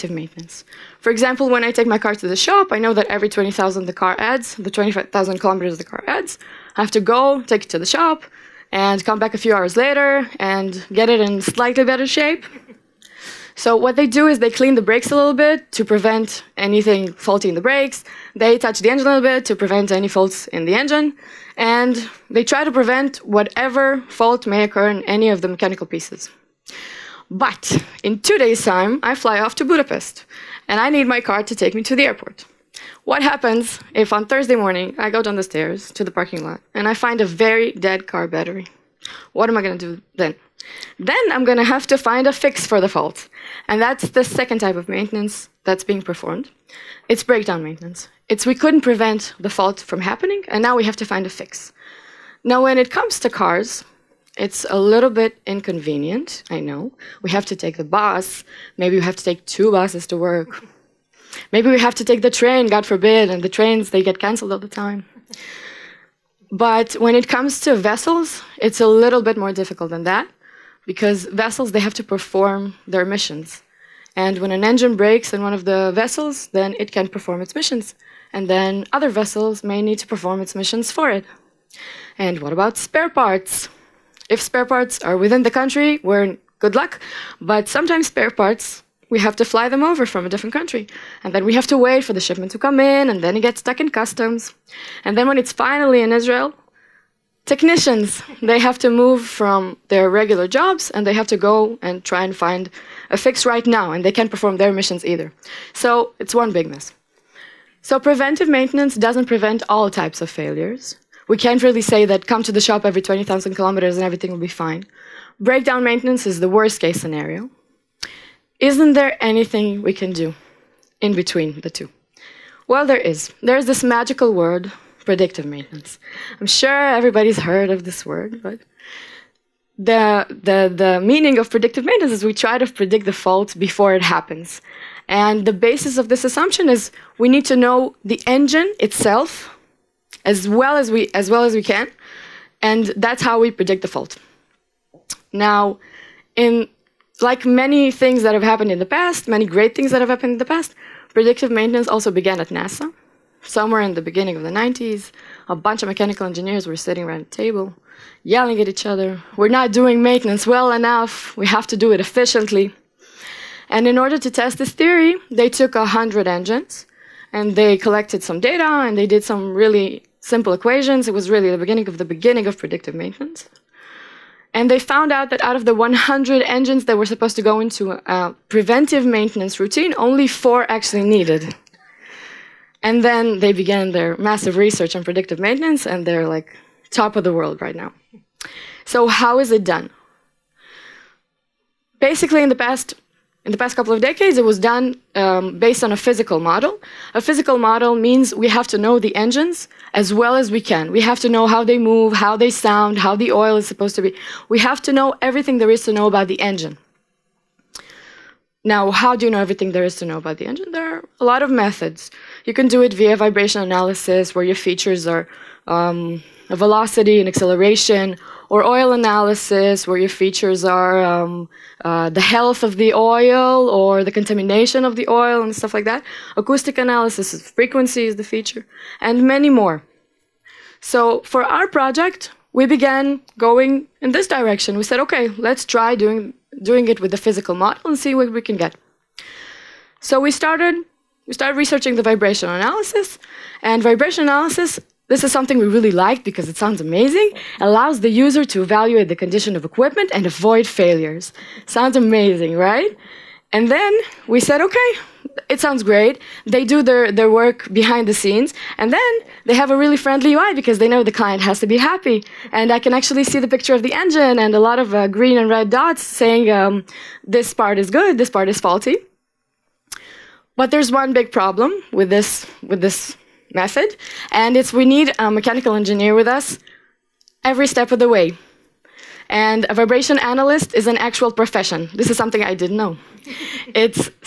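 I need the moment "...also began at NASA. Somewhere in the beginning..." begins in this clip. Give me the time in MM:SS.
02:31.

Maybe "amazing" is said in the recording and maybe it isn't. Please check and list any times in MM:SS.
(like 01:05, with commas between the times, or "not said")
04:06, 04:11.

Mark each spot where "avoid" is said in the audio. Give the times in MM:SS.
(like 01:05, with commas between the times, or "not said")
04:10.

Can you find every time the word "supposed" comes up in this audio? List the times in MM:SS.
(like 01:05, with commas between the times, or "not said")
02:57, 03:23.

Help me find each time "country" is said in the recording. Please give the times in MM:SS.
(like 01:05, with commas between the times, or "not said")
01:25, 01:30.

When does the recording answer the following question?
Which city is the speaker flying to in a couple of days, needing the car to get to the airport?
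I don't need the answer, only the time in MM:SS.
00:29.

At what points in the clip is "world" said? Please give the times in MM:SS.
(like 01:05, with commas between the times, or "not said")
03:07.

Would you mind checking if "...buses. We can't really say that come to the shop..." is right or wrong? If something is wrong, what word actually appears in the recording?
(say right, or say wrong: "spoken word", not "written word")
wrong: "failures", not "buses".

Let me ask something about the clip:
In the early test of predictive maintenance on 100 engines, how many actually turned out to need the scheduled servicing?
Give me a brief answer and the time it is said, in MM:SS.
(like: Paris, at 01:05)
4, at 03:00.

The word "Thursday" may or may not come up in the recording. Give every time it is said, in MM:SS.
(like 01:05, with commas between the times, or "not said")
00:34.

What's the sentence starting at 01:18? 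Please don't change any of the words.
And then other vessels may need to perform its missions for it.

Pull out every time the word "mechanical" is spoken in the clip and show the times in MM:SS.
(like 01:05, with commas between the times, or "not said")
00:25, 02:35, 04:35.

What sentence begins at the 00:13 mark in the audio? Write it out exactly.
So what they do is they clean the brakes a little bit to prevent anything faulty in the brakes.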